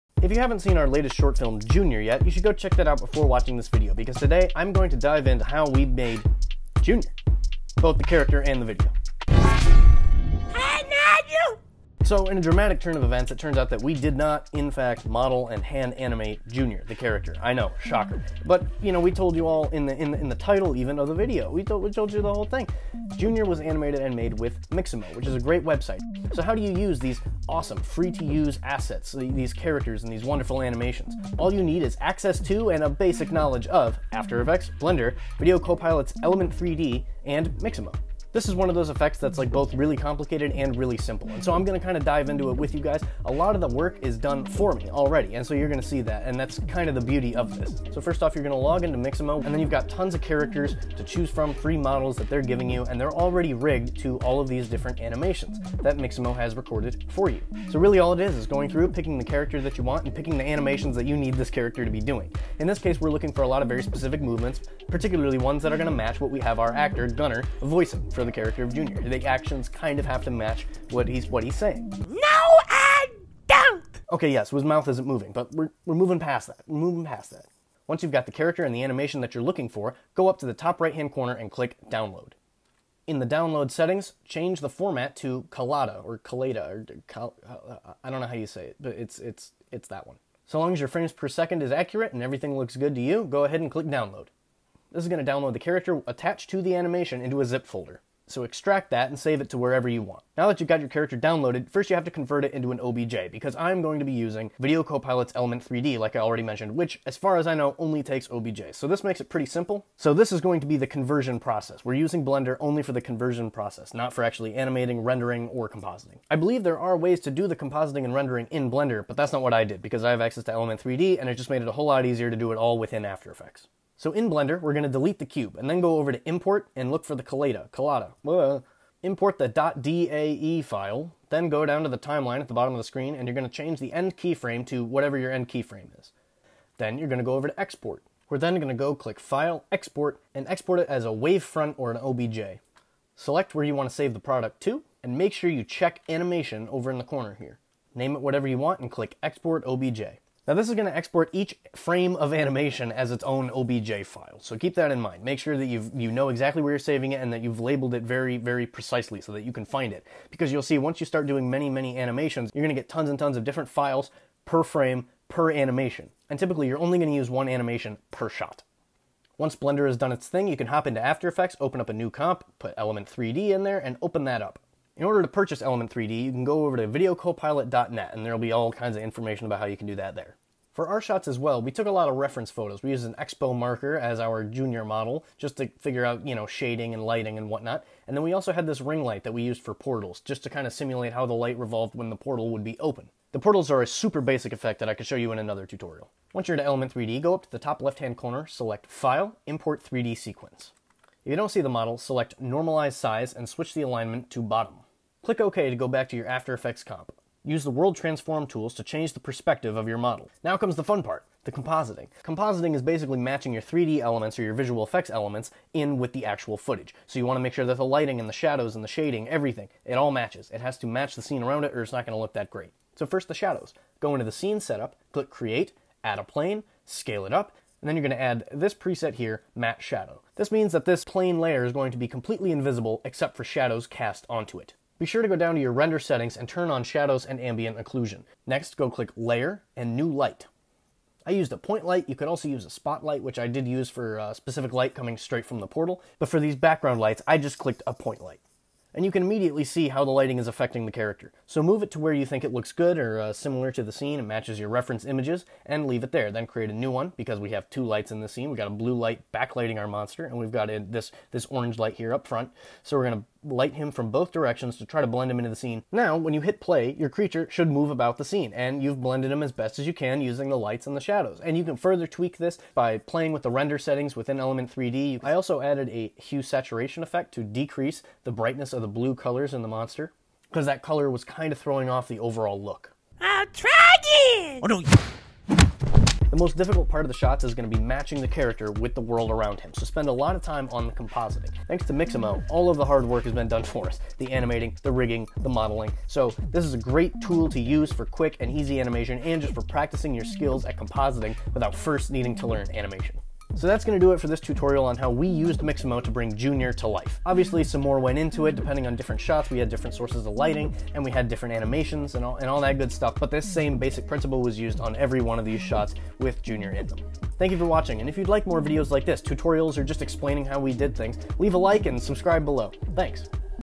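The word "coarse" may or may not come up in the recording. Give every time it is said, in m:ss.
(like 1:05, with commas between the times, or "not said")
not said.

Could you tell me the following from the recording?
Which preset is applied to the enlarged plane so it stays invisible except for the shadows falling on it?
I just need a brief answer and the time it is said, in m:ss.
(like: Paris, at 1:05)
Matte shadow, at 3:49.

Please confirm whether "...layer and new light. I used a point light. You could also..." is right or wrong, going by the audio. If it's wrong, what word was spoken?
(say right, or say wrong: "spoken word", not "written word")
right.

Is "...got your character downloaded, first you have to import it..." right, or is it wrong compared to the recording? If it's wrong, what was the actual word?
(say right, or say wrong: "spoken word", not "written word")
wrong: "convert", not "import".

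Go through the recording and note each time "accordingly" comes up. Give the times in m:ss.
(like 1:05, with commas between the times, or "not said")
not said.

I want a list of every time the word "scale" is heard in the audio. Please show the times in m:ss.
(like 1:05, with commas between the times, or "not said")
3:46.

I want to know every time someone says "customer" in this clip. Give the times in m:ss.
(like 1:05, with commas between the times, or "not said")
not said.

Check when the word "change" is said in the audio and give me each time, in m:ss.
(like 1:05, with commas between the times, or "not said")
1:24, 2:13, 3:28.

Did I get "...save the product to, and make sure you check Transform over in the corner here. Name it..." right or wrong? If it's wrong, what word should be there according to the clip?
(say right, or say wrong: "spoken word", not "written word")
wrong: "Animation", not "Transform".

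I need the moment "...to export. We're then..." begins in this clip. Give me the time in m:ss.
2:17.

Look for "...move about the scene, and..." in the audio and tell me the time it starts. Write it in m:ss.
4:27.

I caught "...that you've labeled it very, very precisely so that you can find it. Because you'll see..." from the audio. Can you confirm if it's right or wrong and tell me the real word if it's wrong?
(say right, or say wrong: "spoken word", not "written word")
right.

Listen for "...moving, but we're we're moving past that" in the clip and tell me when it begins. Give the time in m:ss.
1:15.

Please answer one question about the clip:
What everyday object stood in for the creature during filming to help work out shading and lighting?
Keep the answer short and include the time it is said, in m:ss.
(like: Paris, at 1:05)
An expo marker, at 3:03.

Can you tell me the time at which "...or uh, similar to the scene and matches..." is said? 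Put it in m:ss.
4:12.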